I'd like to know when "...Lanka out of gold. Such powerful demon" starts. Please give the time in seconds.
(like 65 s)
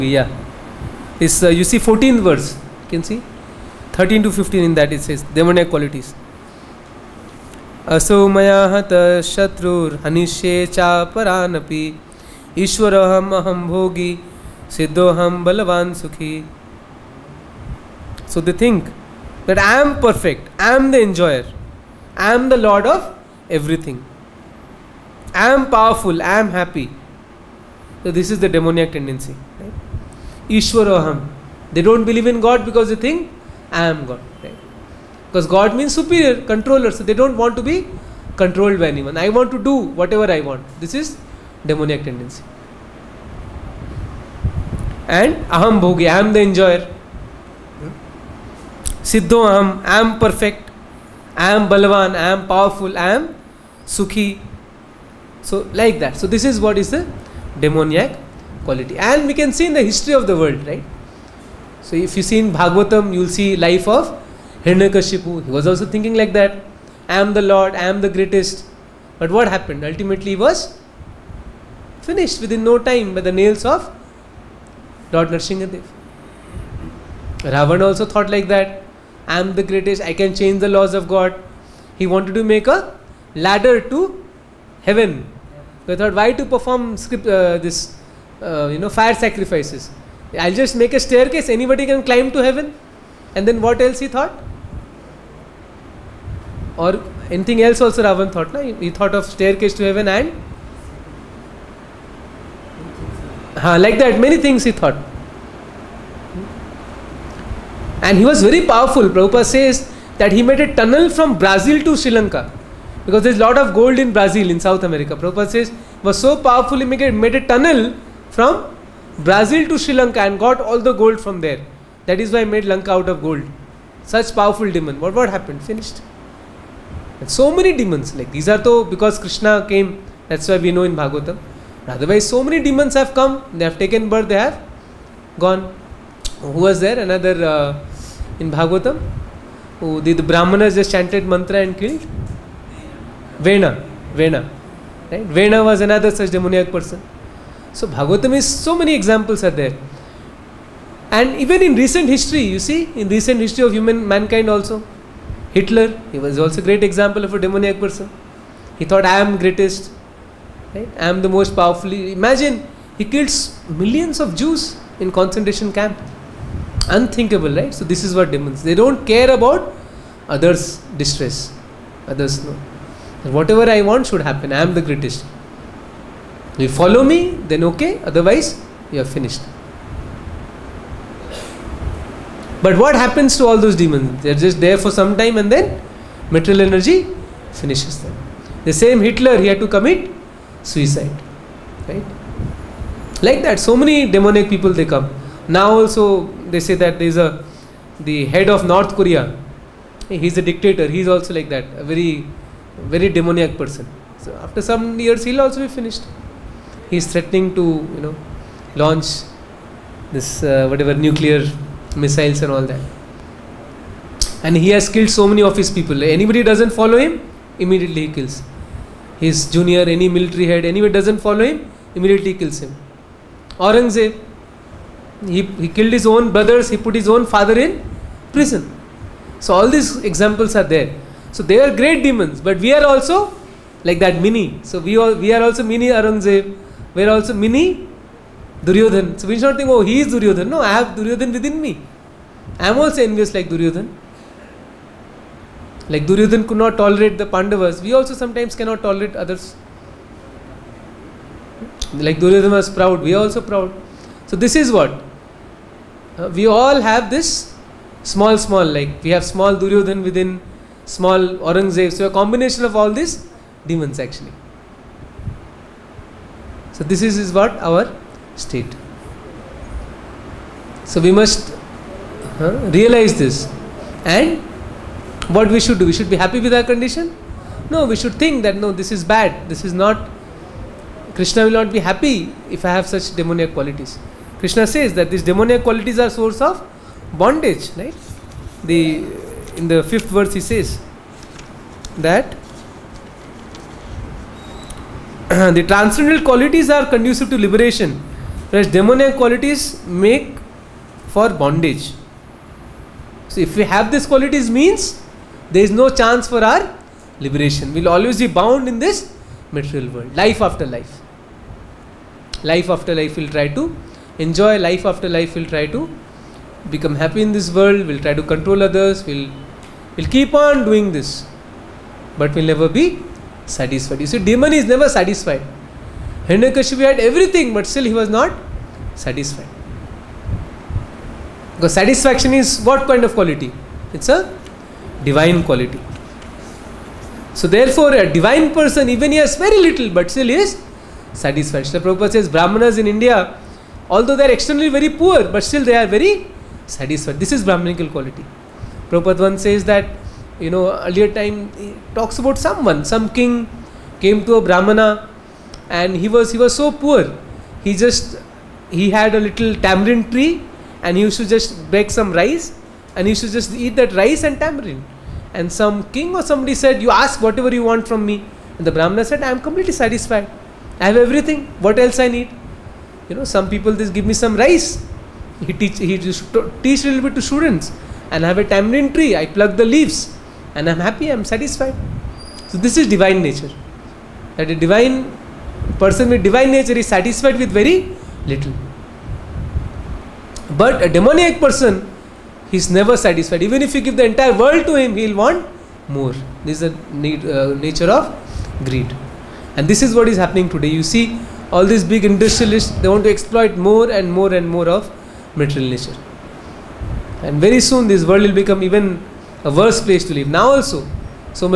122 s.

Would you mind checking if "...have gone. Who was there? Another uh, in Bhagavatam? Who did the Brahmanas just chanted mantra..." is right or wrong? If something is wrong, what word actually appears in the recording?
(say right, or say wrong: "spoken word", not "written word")
right.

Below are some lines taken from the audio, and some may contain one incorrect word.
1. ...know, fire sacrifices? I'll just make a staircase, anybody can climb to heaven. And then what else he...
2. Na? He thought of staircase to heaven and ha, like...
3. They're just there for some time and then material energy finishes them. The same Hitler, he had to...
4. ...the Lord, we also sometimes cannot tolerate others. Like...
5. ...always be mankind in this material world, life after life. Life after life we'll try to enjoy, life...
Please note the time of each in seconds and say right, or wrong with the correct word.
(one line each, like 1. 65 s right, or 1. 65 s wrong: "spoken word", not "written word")
1. 88 s right
2. 98 s right
3. 184 s right
4. 247 s wrong: "Pandavas", not "Lord"
5. 307 s wrong: "bound", not "mankind".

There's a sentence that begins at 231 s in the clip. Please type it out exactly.
So they are great demons, but we are also like that mini.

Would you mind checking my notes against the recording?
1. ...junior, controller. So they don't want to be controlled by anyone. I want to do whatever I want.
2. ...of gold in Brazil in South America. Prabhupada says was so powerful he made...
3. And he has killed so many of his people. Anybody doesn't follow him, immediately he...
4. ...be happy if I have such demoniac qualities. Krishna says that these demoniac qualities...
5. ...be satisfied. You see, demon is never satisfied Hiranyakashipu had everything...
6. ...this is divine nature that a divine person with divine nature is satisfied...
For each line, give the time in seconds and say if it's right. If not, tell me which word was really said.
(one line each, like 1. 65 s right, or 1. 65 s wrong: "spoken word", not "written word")
1. 35 s wrong: "superior", not "junior"
2. 113 s right
3. 214 s right
4. 281 s right
5. 322 s right
6. 382 s right.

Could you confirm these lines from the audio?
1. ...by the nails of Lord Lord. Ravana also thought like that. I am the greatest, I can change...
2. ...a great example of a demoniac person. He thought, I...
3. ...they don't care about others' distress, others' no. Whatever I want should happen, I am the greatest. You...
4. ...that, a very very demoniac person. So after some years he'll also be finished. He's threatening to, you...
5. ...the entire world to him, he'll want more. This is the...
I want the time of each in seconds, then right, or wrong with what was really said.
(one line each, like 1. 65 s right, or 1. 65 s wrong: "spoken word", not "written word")
1. 73 s wrong: "Narsingadev", not "Lord"
2. 156 s right
3. 168 s right
4. 201 s right
5. 393 s right.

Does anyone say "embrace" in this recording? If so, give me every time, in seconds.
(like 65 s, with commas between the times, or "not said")
not said.